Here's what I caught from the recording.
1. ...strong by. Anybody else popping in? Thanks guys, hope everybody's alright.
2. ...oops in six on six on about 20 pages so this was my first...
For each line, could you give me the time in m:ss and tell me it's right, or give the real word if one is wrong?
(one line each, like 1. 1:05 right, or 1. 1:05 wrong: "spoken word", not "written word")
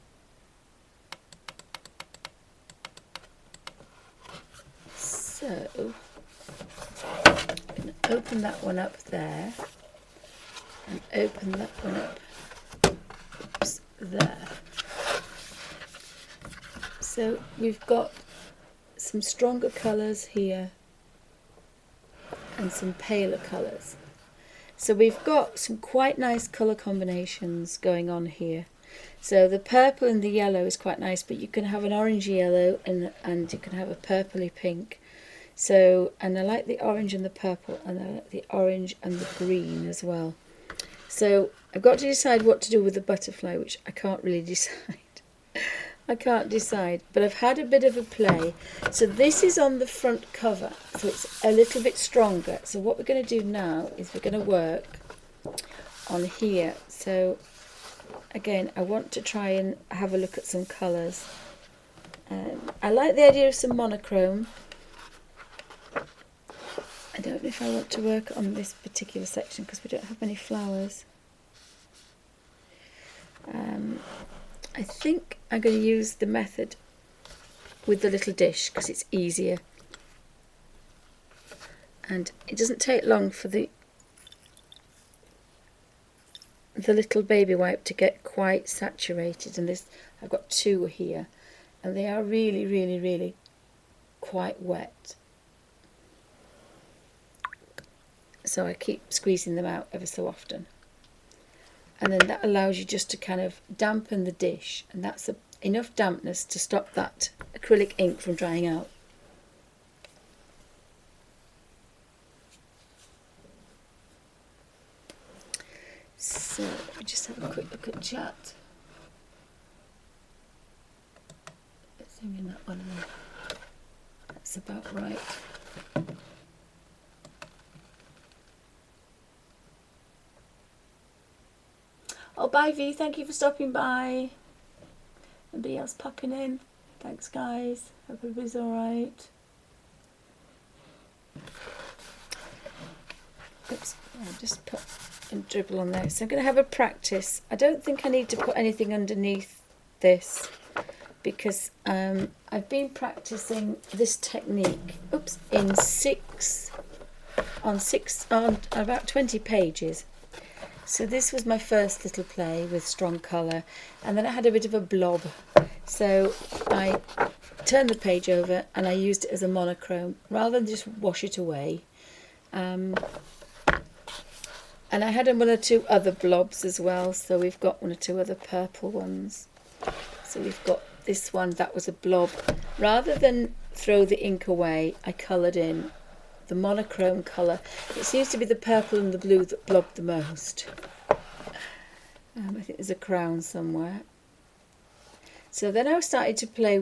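1. 2:13 wrong: "stopping", not "strong"
2. 2:35 right.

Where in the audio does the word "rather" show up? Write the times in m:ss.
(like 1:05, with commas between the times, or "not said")
2:50, 3:02.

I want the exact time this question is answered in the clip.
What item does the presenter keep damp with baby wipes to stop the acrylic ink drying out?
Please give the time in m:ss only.
1:18.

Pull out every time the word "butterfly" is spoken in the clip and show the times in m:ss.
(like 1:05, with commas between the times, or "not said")
0:43.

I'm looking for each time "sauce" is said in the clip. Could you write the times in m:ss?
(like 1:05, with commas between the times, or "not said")
not said.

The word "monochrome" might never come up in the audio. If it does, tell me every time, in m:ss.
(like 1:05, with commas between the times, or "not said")
1:03, 2:49, 3:06.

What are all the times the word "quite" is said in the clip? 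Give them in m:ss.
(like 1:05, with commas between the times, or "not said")
0:25, 0:30, 1:28, 1:34.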